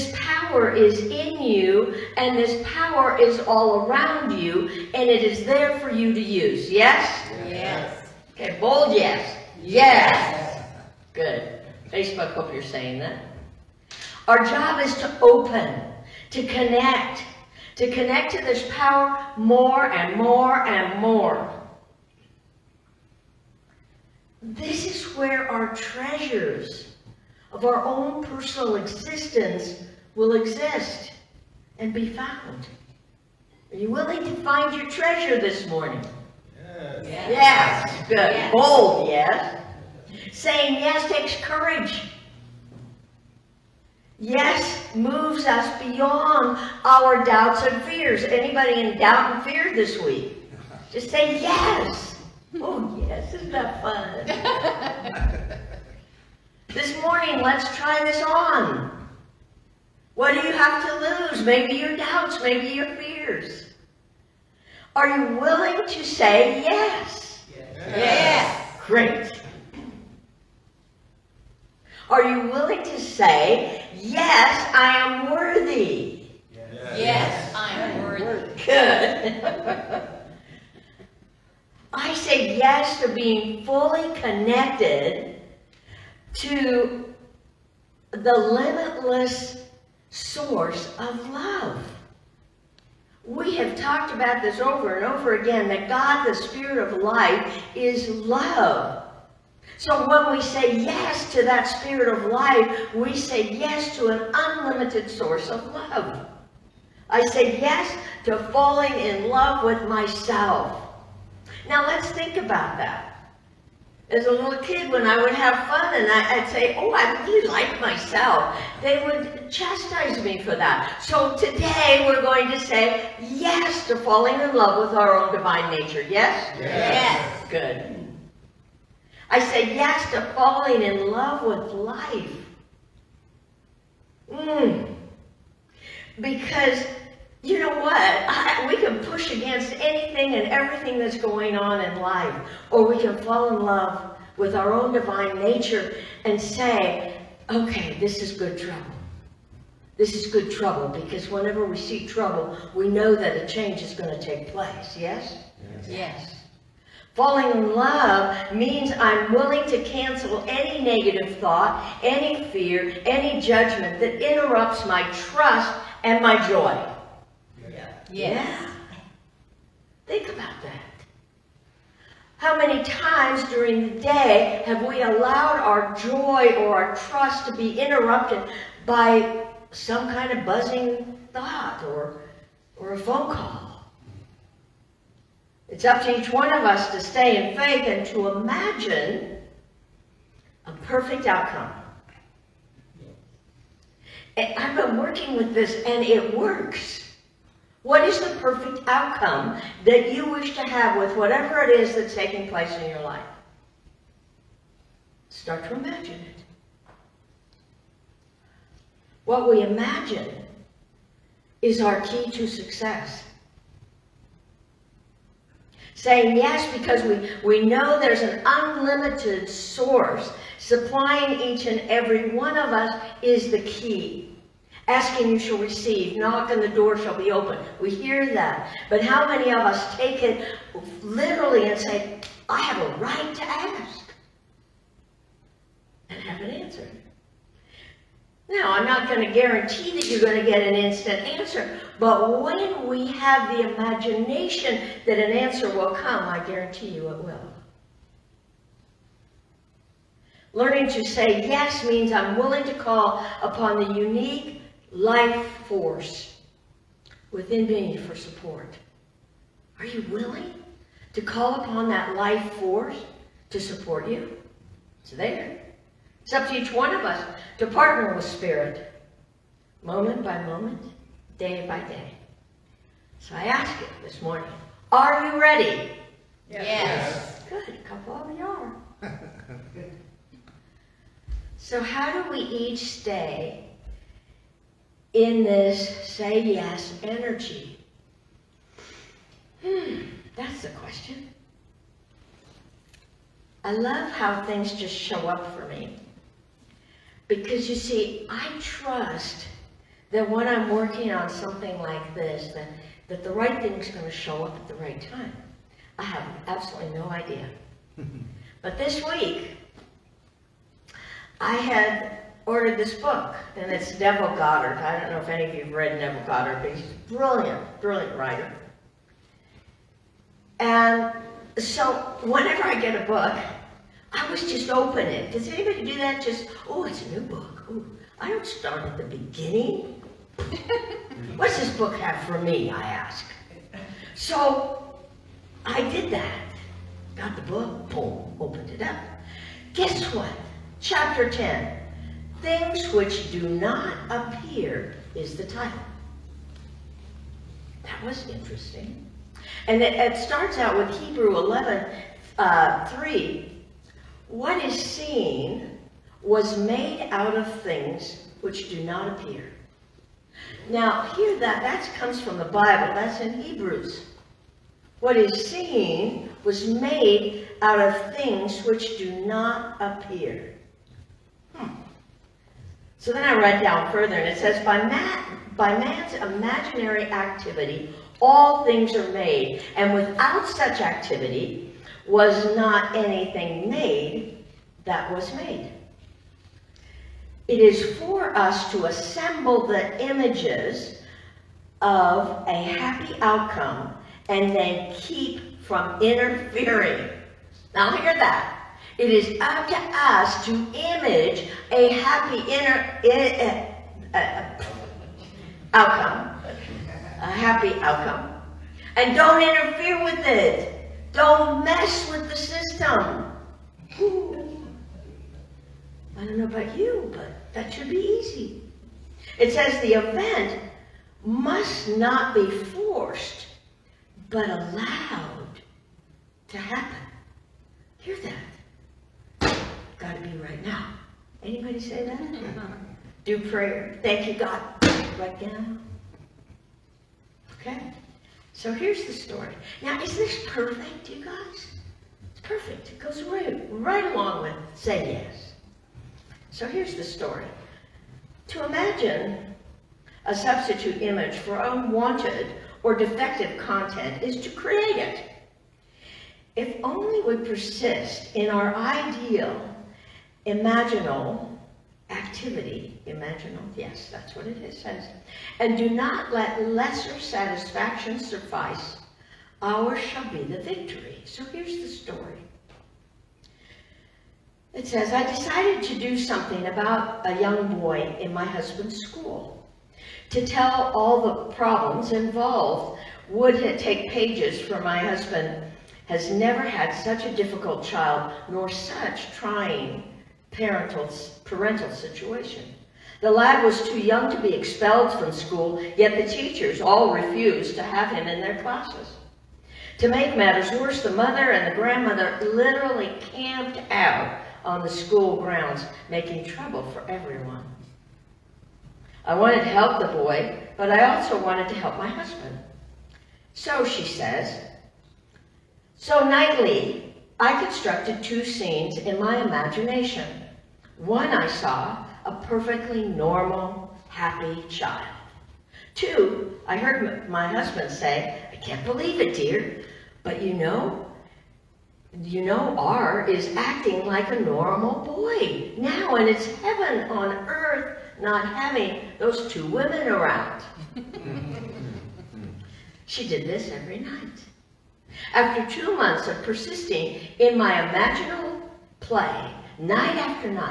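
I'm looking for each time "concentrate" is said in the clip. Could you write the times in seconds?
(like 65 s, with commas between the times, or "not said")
not said.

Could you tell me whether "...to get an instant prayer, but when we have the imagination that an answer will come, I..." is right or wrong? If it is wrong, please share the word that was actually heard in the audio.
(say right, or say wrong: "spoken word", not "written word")
wrong: "answer", not "prayer".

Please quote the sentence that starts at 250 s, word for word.
Learning to say yes means I'm willing to call upon the unique life force within me for support.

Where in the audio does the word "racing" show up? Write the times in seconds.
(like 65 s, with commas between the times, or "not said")
not said.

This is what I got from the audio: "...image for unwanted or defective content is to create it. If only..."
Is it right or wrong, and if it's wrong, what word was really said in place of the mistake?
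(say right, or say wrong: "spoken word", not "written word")
right.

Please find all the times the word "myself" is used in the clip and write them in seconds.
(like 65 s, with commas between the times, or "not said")
109 s, 117 s.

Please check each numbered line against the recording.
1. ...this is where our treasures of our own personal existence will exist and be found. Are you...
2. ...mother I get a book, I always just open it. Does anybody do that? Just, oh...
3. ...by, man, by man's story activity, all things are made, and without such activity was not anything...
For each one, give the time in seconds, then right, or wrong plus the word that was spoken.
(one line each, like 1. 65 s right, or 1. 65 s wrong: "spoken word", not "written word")
1. 24 s right
2. 322 s wrong: "whenever", not "mother"
3. 374 s wrong: "imaginary", not "story".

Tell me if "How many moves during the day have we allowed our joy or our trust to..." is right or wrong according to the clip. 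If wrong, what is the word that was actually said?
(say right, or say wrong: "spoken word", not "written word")
wrong: "times", not "moves".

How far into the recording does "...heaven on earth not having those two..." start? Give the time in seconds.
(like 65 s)
536 s.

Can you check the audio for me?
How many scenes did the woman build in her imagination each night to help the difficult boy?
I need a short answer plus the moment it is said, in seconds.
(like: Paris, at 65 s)
2, at 518 s.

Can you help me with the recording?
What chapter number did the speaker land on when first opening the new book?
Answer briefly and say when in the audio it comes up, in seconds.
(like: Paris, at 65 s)
10, at 340 s.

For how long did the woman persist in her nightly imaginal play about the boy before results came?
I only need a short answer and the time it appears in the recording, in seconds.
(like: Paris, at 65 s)
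2 months, at 545 s.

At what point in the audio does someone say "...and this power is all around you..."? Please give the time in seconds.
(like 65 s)
2 s.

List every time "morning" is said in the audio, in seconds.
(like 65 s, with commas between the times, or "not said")
35 s, 57 s, 274 s.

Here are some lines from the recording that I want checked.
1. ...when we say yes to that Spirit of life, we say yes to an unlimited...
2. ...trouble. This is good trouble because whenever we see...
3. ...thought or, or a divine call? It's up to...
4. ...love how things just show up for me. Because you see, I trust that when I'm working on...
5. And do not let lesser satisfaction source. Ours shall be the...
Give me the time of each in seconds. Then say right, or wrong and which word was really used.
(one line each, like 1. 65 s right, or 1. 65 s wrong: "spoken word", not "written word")
1. 100 s right
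2. 148 s right
3. 181 s wrong: "phone", not "divine"
4. 293 s right
5. 465 s wrong: "suffice", not "source".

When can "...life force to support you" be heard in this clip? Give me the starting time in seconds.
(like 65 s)
262 s.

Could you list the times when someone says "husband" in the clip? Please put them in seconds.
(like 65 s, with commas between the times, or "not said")
478 s, 484 s, 512 s, 527 s.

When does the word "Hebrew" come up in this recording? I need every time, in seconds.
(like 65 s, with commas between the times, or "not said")
350 s, 363 s.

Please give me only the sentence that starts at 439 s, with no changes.
Now, is this perfect, you guys?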